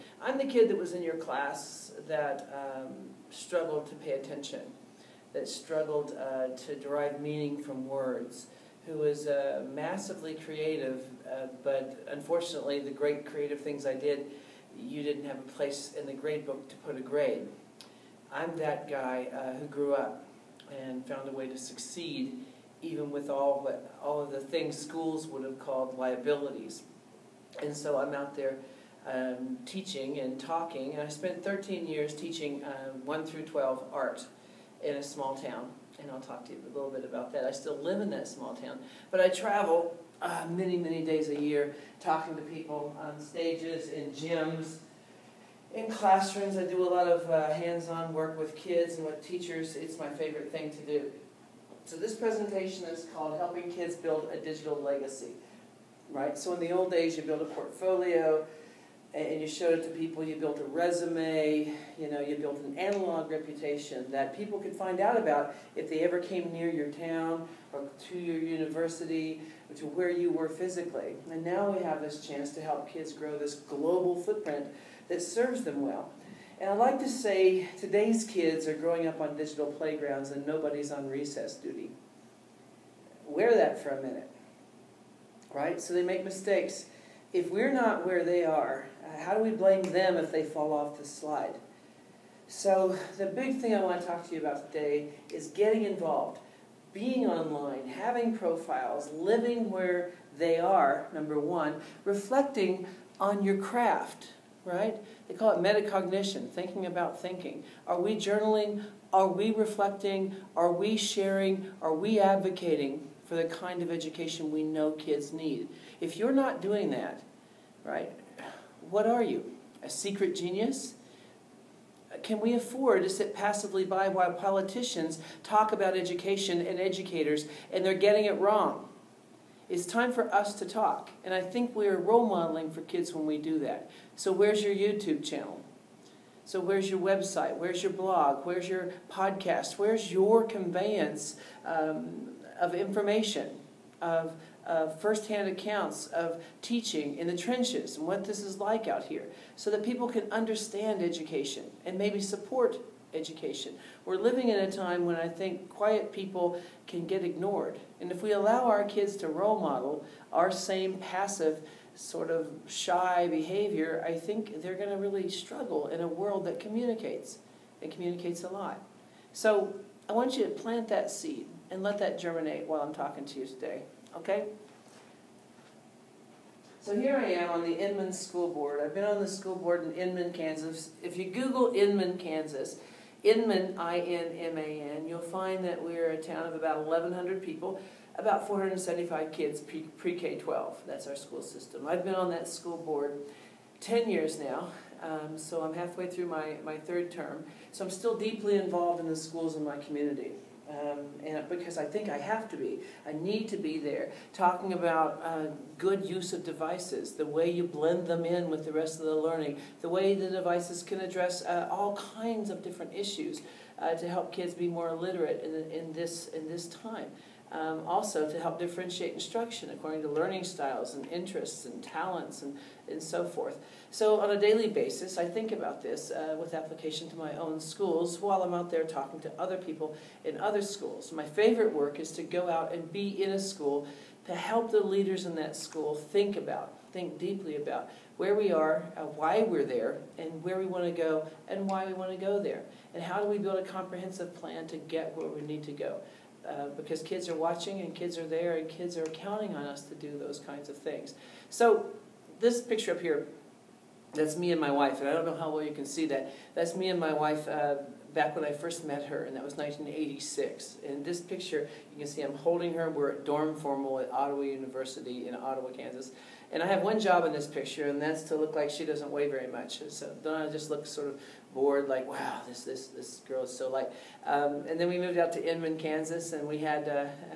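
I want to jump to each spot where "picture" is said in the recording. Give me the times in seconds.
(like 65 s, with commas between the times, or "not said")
252 s, 261 s, 267 s.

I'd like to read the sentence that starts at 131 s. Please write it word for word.
And I think we're role modeling for kids when we do that.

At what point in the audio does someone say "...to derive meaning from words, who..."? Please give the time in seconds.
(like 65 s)
6 s.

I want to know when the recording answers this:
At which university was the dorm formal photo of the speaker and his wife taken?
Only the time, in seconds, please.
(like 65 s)
264 s.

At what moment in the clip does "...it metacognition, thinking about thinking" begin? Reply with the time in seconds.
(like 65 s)
105 s.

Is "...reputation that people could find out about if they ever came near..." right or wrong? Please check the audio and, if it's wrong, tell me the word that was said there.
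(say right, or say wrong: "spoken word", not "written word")
right.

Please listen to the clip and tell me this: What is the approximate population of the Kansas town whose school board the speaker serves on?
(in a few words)
1,100.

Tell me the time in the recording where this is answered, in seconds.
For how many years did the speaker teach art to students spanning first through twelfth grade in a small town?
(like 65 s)
31 s.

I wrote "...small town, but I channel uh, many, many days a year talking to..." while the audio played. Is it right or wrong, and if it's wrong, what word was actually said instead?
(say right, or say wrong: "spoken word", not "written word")
wrong: "travel", not "channel".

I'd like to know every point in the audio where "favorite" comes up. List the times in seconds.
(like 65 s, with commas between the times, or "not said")
50 s, 231 s.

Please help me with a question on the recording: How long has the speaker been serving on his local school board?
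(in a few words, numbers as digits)
10 years.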